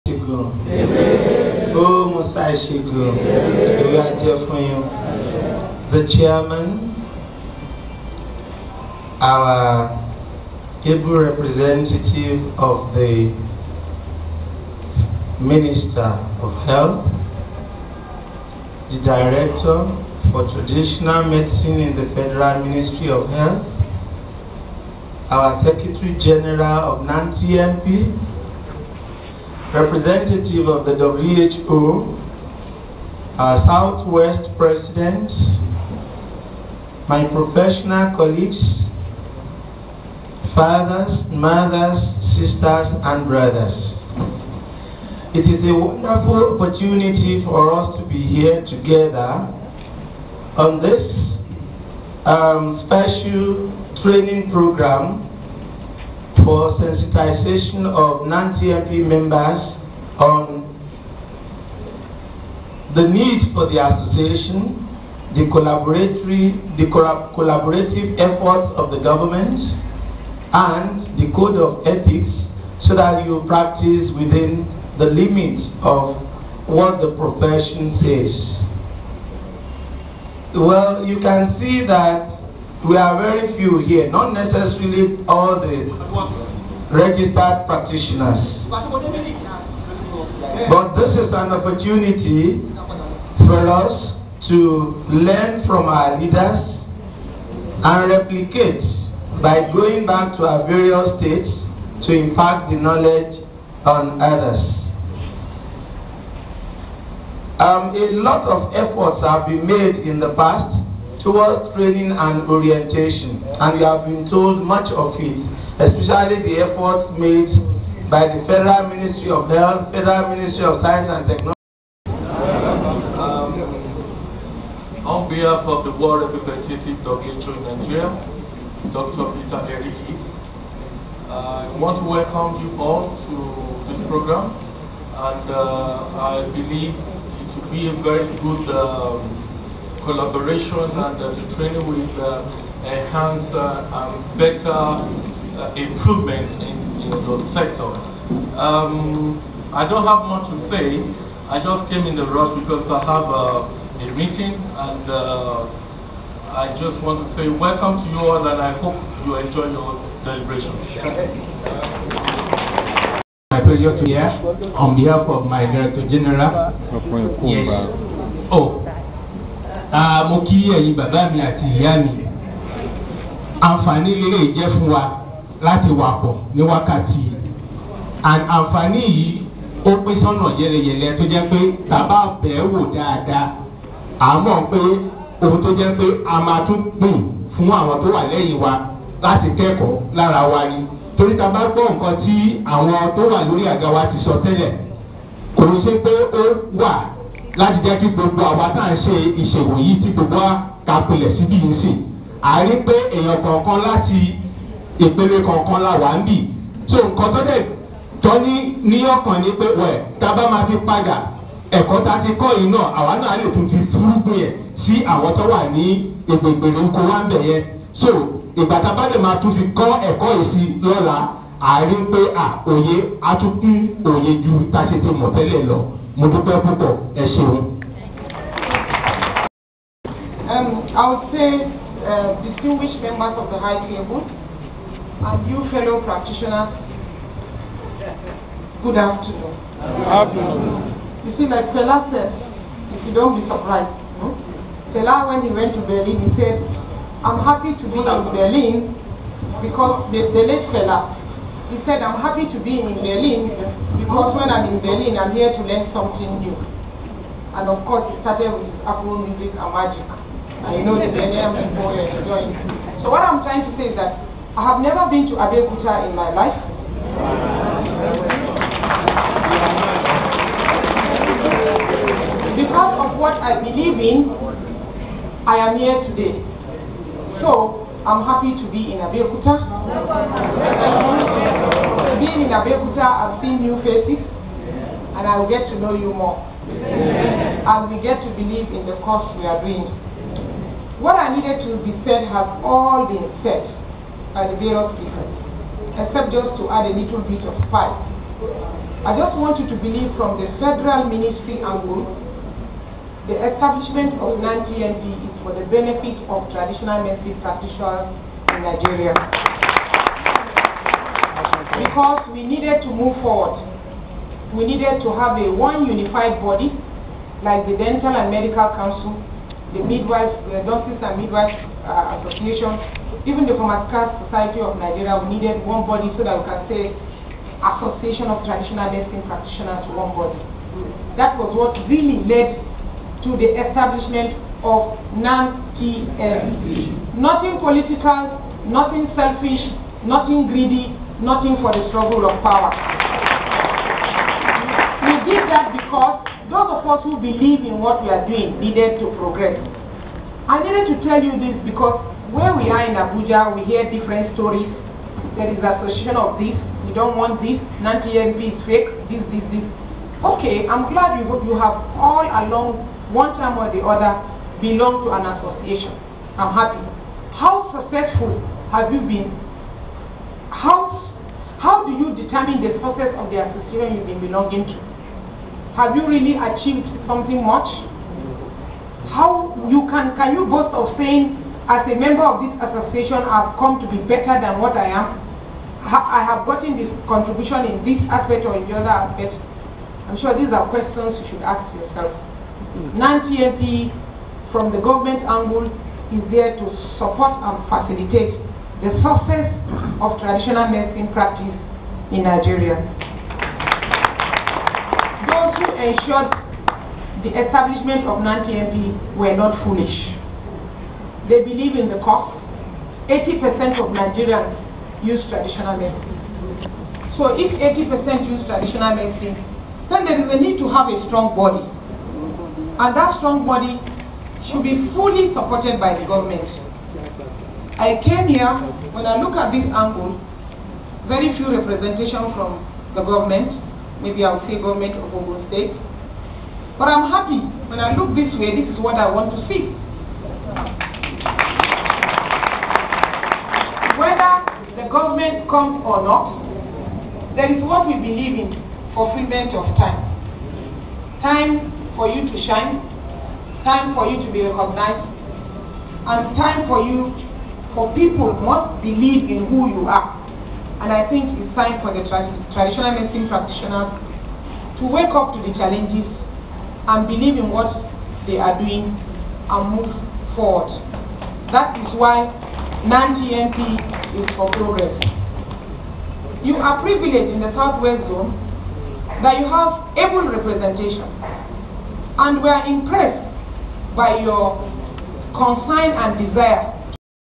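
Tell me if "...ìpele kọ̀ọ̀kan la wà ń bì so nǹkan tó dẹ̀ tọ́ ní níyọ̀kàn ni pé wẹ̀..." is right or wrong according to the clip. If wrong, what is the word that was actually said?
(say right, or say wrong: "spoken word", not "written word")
right.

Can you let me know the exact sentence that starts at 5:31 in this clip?
That was what really led to the establishment of non Nothing political, nothing selfish, nothing greedy, nothing for the struggle of power.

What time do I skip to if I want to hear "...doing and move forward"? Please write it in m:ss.
7:48.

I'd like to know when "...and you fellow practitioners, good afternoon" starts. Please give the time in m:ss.
3:54.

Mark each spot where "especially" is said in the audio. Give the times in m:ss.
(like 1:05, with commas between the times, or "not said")
1:55.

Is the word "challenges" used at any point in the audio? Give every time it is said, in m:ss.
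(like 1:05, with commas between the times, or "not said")
7:45.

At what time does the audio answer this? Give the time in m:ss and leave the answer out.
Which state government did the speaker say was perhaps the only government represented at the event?
7:15.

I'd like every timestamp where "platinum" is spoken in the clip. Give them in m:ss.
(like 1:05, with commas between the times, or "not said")
not said.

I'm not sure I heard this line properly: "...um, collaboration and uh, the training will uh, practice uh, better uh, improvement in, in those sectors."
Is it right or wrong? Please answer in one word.
wrong.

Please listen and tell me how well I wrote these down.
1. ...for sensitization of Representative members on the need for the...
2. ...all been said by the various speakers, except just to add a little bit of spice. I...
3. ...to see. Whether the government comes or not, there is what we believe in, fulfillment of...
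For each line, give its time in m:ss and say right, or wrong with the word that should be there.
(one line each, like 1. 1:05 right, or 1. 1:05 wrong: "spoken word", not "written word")
1. 0:56 wrong: "NANTMP", not "Representative"
2. 4:52 right
3. 7:19 right.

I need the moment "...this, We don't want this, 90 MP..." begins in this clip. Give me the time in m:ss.
5:56.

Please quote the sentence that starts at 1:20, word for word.
Well, you can see that we are very few here, not necessarily all the registered practitioners.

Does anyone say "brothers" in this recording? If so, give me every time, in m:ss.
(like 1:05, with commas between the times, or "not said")
0:43.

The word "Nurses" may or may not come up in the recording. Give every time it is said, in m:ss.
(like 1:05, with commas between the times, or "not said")
5:20.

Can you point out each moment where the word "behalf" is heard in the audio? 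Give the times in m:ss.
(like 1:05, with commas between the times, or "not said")
2:05, 2:44.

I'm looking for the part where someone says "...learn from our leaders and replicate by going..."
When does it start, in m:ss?
1:35.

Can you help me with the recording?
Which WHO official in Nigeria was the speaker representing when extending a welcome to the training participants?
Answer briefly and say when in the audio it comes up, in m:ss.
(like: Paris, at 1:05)
Dr. Peter Eriki, at 2:08.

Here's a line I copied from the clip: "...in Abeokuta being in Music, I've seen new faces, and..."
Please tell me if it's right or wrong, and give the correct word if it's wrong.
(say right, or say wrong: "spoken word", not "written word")
wrong: "Abeokuta", not "Music".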